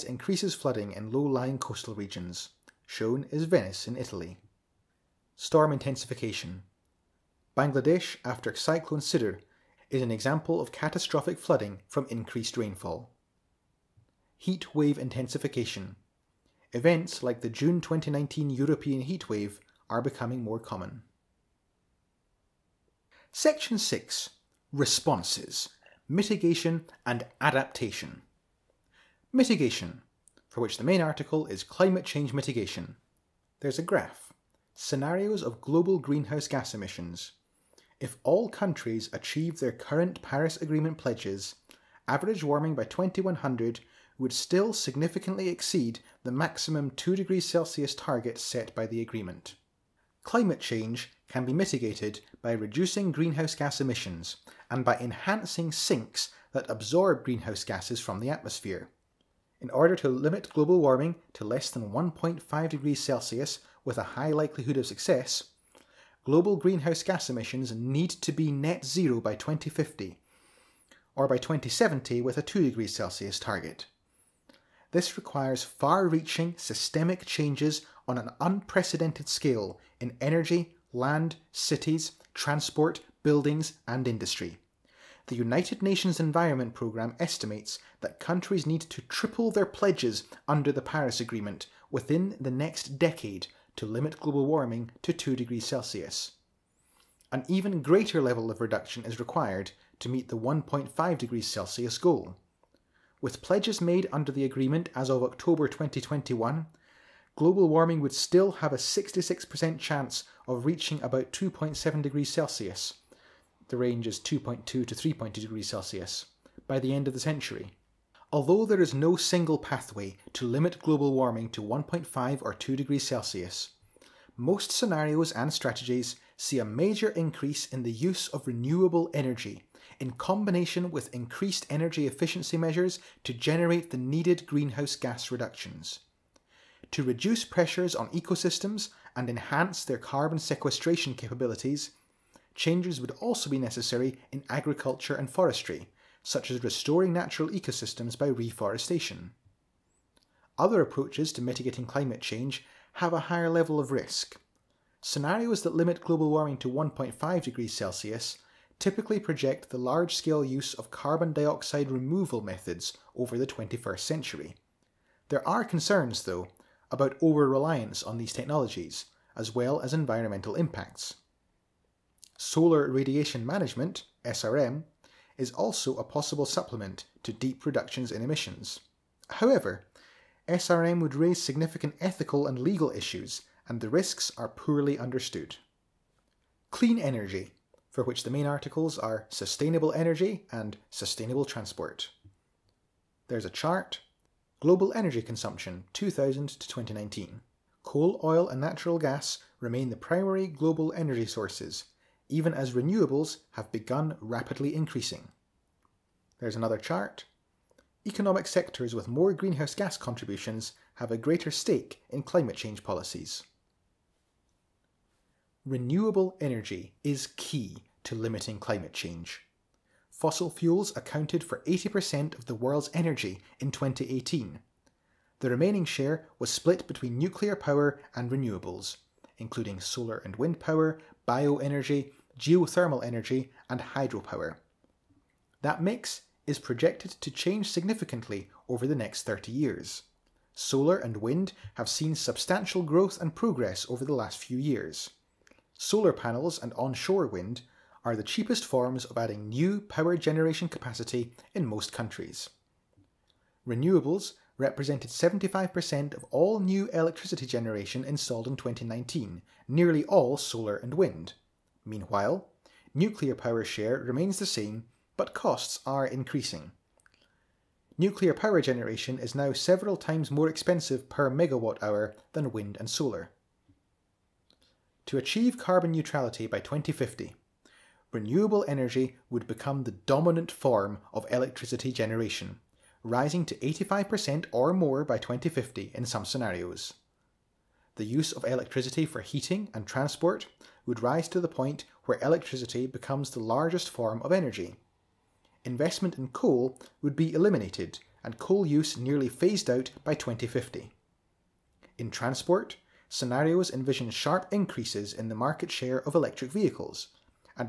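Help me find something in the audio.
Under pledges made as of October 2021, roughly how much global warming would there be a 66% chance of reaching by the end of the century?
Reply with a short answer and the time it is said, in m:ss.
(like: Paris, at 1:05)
2.7 degrees Celsius, at 1:51.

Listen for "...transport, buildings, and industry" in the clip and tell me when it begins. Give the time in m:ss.
1:22.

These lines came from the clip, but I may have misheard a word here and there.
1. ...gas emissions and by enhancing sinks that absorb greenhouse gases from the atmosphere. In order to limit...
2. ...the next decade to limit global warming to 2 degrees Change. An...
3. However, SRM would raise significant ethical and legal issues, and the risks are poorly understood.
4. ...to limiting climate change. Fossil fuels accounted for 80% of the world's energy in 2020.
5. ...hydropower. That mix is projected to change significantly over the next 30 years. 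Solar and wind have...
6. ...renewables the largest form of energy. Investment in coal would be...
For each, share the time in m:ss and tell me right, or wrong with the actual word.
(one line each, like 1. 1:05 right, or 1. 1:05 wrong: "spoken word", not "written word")
1. 0:53 right
2. 1:32 wrong: "Celsius", not "Change"
3. 2:59 right
4. 3:38 wrong: "2018", not "2020"
5. 3:53 right
6. 4:52 wrong: "becomes", not "renewables".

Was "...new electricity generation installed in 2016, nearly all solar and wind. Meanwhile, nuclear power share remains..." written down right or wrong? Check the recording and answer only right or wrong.
wrong.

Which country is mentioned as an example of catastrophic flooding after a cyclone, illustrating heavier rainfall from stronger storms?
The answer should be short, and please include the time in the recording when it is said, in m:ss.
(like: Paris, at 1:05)
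Bangladesh, at 0:07.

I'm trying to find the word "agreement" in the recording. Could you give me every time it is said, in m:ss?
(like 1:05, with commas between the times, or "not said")
0:40, 0:49, 1:31, 1:44.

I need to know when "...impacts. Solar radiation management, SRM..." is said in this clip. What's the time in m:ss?
2:50.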